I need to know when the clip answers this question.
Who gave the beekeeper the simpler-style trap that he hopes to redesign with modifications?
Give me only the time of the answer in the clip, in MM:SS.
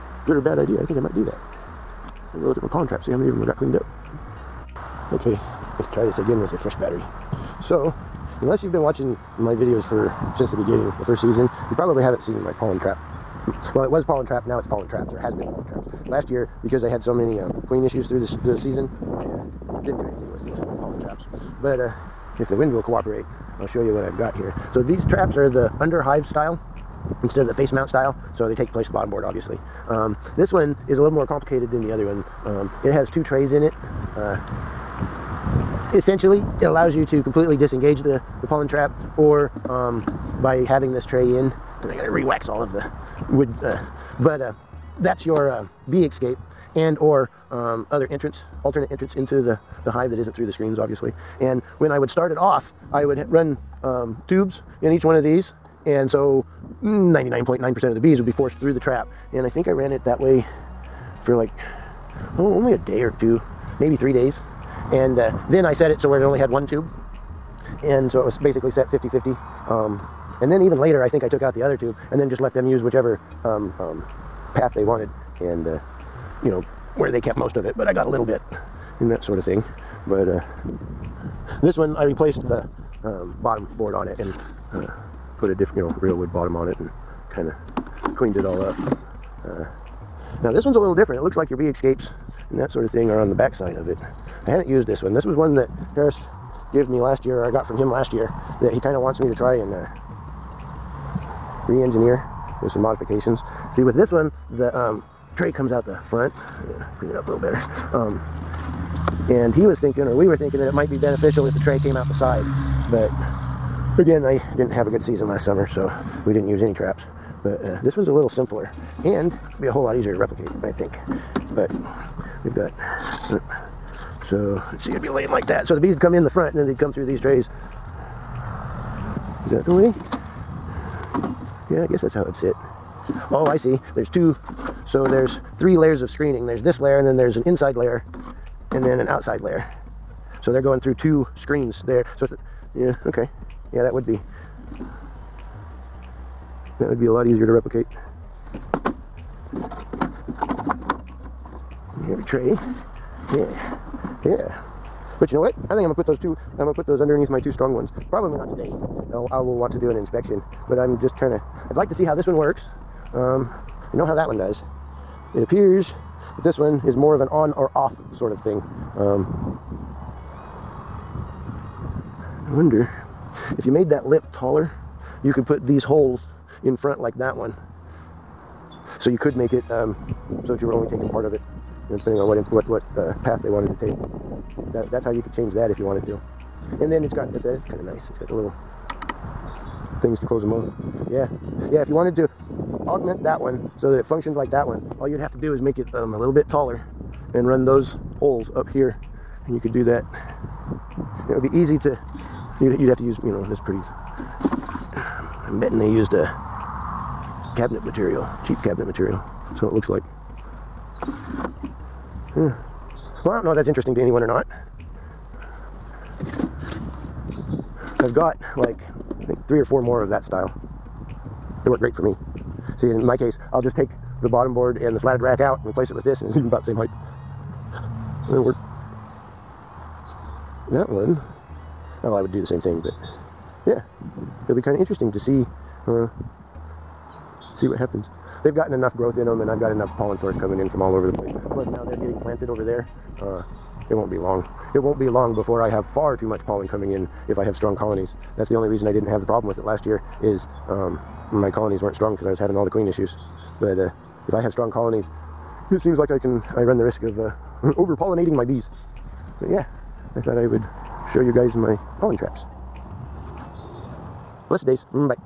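01:35.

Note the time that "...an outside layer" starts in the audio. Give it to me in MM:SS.
02:18.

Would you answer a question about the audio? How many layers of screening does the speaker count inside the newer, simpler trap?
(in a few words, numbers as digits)
3.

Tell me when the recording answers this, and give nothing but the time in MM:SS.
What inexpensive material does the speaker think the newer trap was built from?
03:28.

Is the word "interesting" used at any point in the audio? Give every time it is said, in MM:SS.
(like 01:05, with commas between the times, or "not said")
03:33, 03:54.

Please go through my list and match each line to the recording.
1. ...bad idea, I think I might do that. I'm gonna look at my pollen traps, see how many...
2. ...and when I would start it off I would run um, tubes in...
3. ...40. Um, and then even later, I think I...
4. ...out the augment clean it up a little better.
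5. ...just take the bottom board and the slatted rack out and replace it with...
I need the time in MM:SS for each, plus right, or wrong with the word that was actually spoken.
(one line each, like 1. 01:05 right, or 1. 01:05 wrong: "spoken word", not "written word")
1. 00:00 right
2. 00:51 right
3. 01:09 wrong: "50", not "40"
4. 01:45 wrong: "front", not "augment"
5. 03:43 right.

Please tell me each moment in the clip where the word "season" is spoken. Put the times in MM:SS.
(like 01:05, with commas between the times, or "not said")
00:11, 00:18, 01:55.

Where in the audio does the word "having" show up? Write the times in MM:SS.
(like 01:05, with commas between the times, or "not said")
00:40, 04:12.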